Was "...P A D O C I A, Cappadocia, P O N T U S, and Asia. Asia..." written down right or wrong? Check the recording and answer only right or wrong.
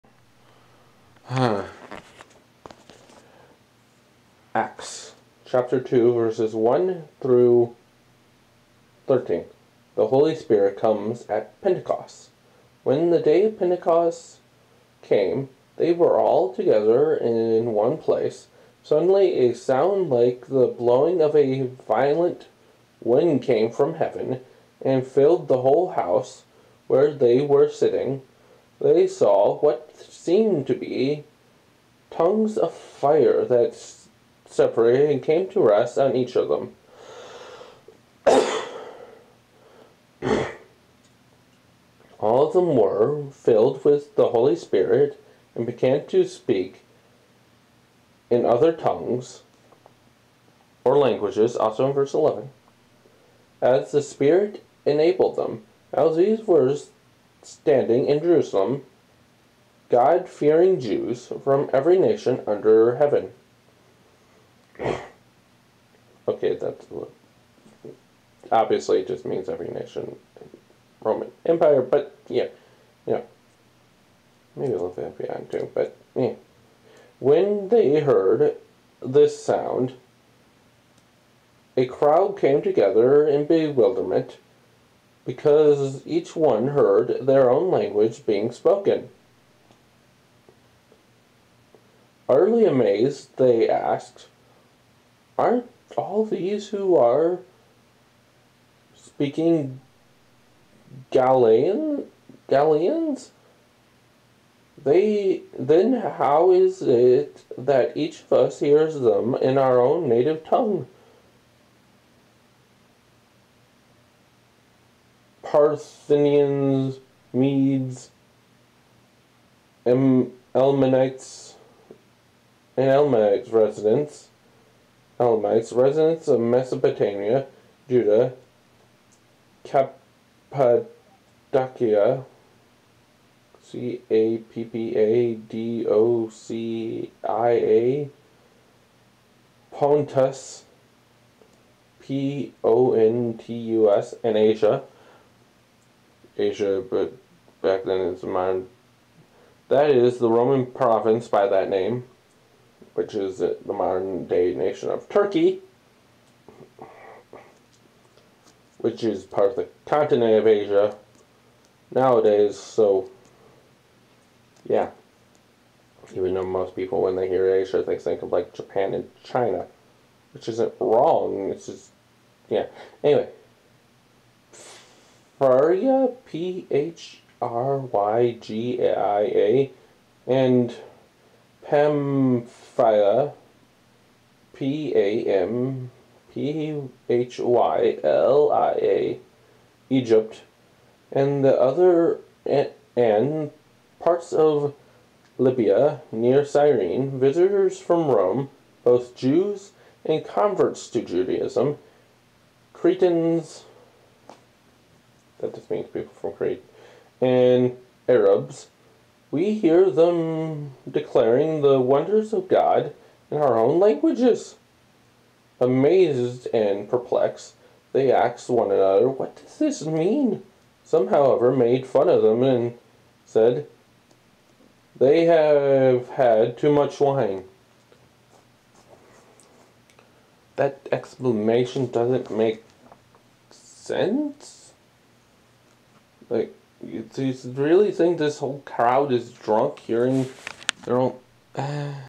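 wrong.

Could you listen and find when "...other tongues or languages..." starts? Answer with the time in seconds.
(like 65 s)
48 s.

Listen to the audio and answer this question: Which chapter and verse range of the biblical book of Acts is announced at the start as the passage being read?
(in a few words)
Chapter 2, verses 1-13.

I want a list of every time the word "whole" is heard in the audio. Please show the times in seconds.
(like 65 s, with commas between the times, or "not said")
25 s, 238 s.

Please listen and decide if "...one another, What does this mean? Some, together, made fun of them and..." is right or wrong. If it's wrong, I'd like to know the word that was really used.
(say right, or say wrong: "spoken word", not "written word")
wrong: "however", not "together".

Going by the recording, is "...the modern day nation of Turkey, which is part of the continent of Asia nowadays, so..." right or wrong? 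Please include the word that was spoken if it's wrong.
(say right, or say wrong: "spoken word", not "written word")
right.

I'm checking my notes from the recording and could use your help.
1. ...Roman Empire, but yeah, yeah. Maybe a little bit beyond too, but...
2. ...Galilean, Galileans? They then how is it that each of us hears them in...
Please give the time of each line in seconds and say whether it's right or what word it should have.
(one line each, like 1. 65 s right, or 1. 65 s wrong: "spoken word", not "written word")
1. 71 s right
2. 101 s right.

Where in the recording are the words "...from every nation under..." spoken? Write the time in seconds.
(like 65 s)
61 s.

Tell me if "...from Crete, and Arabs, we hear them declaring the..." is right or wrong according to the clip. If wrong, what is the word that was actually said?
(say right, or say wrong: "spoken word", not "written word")
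right.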